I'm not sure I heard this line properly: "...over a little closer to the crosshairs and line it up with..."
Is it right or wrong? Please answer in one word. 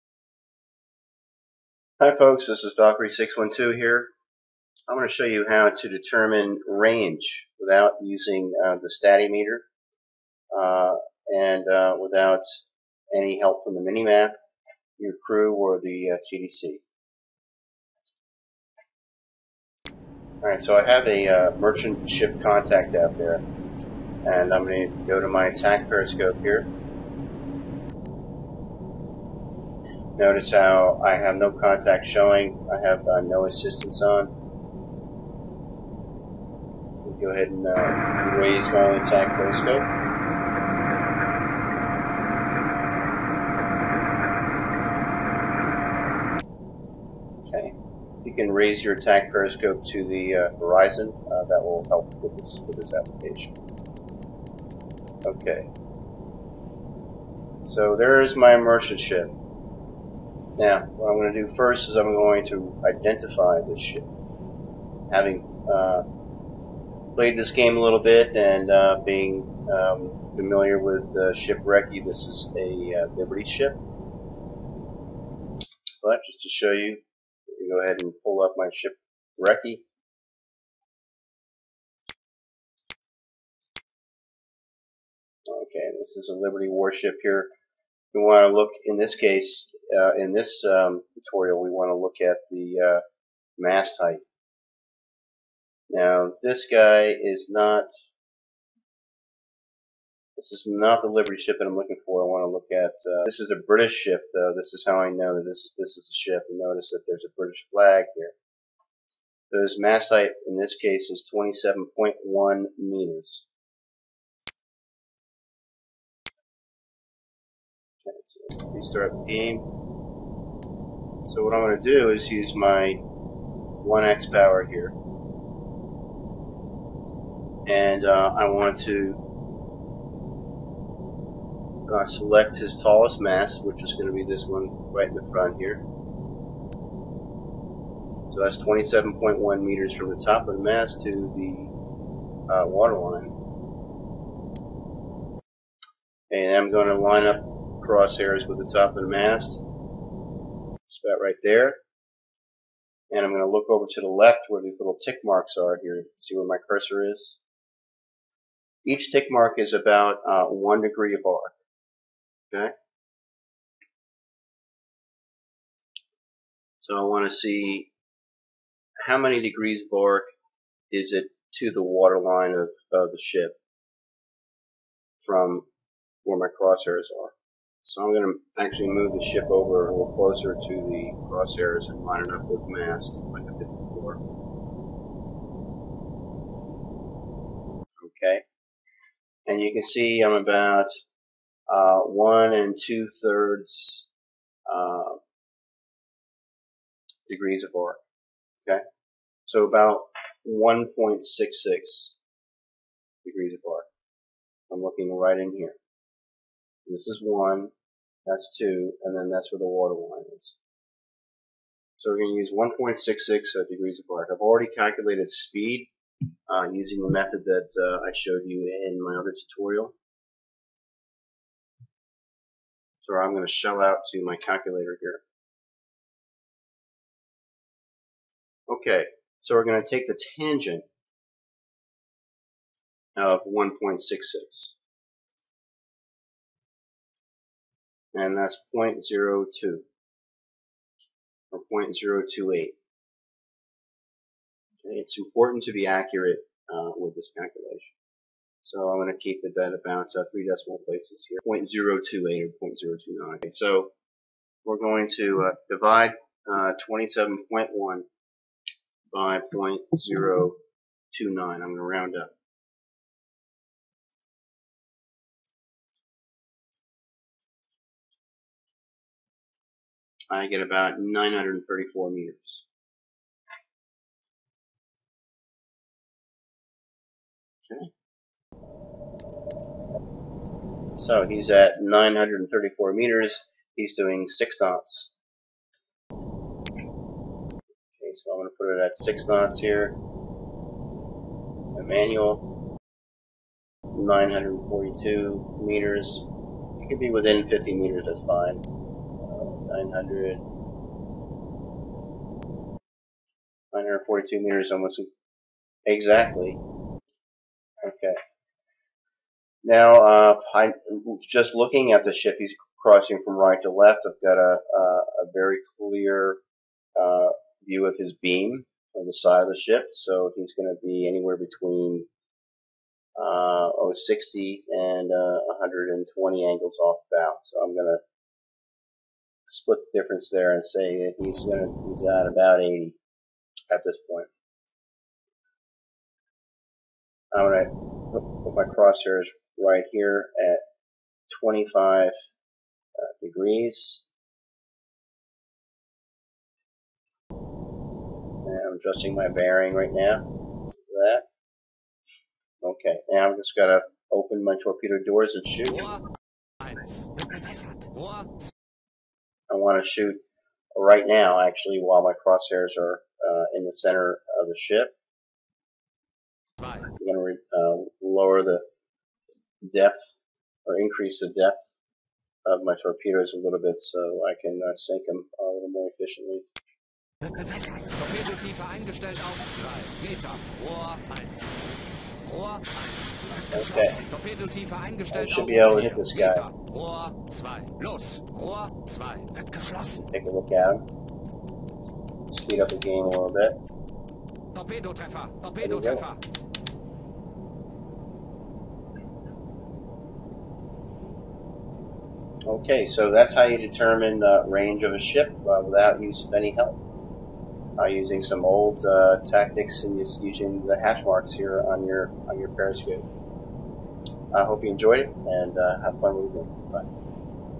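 right.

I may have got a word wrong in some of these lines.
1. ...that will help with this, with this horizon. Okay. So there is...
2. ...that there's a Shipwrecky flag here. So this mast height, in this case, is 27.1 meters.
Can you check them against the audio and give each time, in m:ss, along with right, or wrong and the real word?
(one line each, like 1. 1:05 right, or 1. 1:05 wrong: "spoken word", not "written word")
1. 0:51 wrong: "application", not "horizon"
2. 1:46 wrong: "British", not "Shipwrecky".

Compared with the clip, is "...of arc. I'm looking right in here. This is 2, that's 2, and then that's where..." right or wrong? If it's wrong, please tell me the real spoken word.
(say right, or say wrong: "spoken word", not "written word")
wrong: "1", not "2".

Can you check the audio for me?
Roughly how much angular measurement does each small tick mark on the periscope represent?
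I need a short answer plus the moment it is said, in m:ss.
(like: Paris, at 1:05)
one degree, at 2:40.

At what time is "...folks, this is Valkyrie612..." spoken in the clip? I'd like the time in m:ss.
0:02.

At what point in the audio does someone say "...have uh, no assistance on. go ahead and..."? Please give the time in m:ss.
0:32.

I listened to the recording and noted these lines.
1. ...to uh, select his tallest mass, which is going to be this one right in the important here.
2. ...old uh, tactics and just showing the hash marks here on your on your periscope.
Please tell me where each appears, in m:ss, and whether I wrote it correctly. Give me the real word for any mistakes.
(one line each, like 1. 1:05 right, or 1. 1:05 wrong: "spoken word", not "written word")
1. 2:08 wrong: "front", not "important"
2. 6:48 wrong: "using", not "showing".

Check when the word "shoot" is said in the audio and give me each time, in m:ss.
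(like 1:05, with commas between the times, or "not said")
5:55, 5:59.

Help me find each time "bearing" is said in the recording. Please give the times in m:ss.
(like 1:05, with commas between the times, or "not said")
5:49.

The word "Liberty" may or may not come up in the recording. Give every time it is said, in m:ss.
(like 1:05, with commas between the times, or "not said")
1:13, 1:26, 1:41.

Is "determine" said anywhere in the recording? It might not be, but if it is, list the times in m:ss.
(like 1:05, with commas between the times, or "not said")
0:05, 6:43.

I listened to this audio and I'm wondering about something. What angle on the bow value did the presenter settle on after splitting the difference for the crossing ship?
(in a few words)
80.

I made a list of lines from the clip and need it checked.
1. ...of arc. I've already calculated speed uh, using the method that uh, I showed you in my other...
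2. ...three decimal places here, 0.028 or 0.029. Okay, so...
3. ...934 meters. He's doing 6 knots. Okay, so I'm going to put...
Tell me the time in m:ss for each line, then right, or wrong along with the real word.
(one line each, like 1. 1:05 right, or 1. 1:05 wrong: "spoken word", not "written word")
1. 3:33 right
2. 4:10 right
3. 4:41 right.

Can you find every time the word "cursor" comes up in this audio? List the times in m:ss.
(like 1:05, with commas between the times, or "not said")
2:36.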